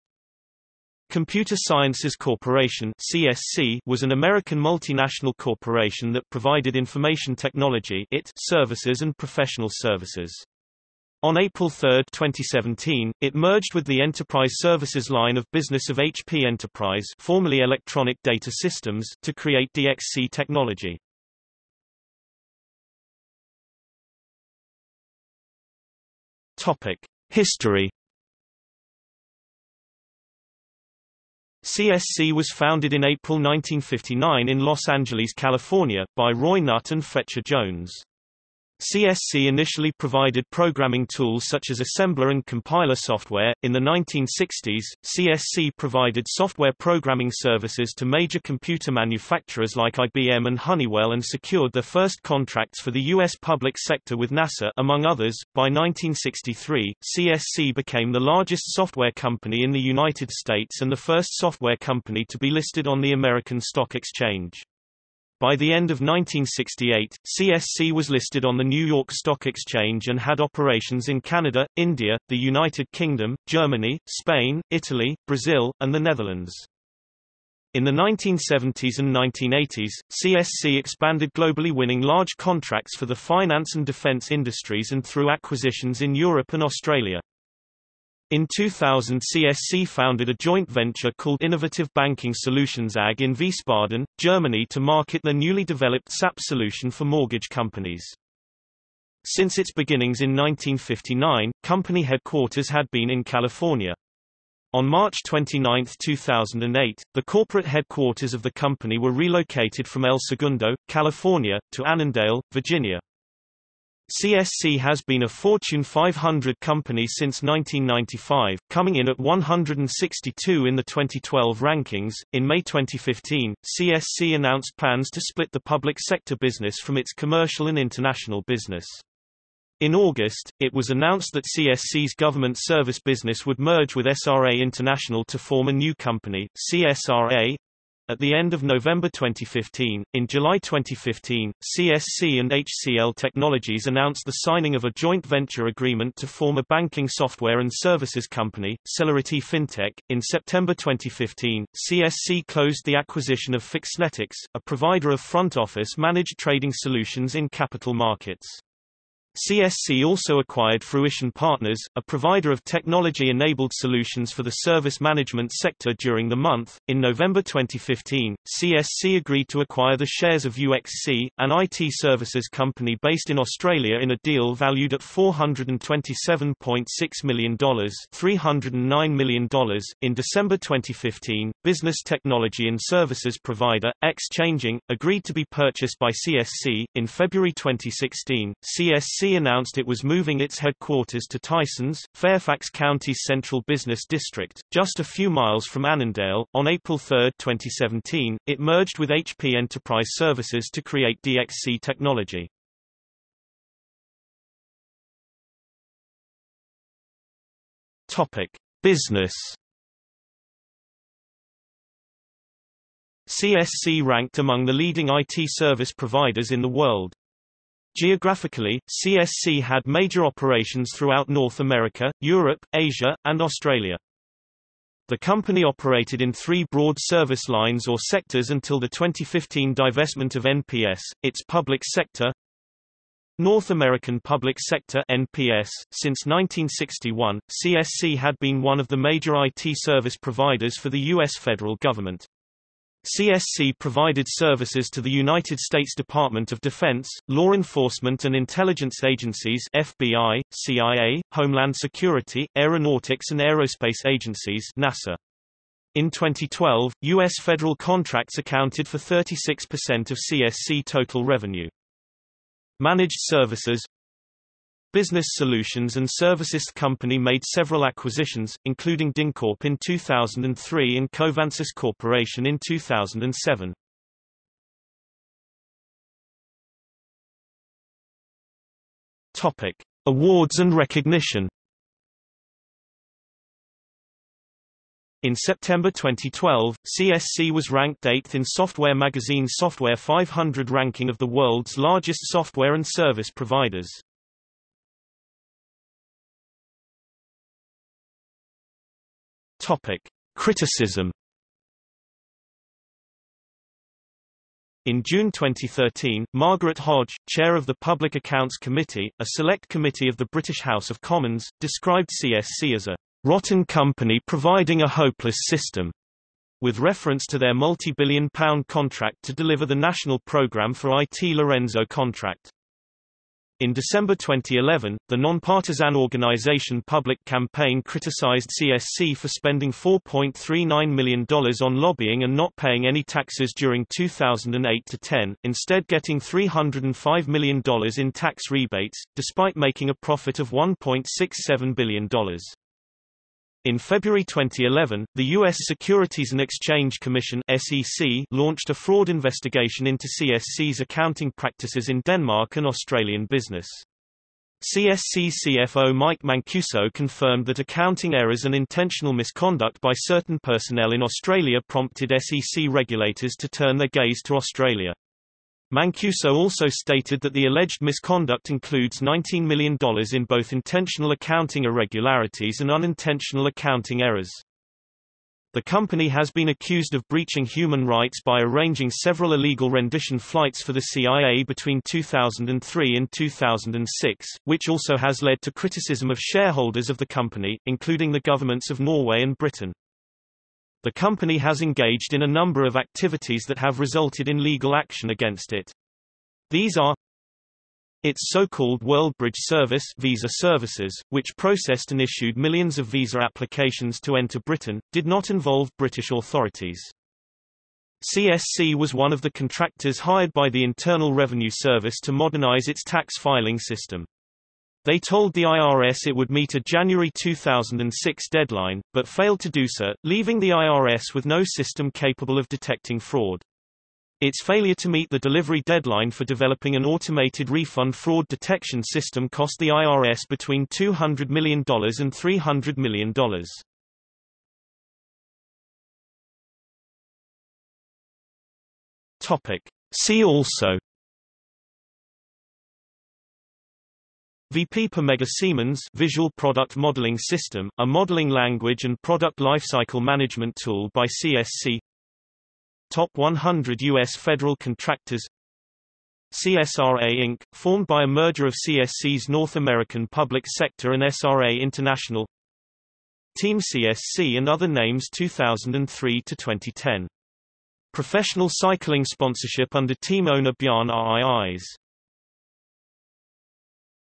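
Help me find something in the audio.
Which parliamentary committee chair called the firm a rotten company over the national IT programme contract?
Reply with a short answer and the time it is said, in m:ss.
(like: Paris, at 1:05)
Margaret Hodge, at 5:06.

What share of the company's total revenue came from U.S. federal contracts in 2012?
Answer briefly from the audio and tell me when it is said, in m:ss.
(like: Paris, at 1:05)
36%, at 4:18.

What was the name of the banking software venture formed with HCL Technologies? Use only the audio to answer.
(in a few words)
Celerity FinTech.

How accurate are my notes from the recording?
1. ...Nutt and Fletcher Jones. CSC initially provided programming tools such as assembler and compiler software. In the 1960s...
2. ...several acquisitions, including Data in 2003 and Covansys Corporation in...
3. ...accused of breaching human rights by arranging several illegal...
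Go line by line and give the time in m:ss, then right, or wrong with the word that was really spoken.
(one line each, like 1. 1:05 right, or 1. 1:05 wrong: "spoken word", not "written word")
1. 0:36 right
2. 4:27 wrong: "DynCorp", not "Data"
3. 6:16 right.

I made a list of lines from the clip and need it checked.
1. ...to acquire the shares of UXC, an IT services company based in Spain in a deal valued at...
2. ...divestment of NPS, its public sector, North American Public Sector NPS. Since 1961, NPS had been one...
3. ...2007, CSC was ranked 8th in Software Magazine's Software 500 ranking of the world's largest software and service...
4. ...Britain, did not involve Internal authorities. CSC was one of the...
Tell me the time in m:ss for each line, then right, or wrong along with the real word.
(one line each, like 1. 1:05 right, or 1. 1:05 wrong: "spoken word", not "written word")
1. 2:49 wrong: "Australia", not "Spain"
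2. 3:49 wrong: "CSC", not "NPS"
3. 4:45 wrong: "2012", not "2007"
4. 6:44 wrong: "British", not "Internal".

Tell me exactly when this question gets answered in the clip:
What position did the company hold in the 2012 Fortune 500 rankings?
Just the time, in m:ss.
1:59.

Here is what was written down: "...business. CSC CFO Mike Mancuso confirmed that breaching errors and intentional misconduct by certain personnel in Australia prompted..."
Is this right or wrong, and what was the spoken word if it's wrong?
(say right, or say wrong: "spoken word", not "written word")
wrong: "accounting", not "breaching".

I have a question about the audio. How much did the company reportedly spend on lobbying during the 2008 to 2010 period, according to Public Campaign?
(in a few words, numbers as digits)
$4.39 million.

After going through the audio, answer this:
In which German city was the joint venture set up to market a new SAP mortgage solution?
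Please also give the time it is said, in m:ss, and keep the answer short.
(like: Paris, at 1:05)
Wiesbaden, at 1:33.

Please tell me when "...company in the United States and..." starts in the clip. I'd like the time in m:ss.
0:59.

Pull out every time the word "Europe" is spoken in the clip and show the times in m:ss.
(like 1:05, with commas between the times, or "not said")
1:26, 3:42.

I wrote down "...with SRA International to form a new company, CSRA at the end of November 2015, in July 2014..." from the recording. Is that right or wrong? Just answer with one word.
wrong.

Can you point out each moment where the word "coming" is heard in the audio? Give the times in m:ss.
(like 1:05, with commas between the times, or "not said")
1:58.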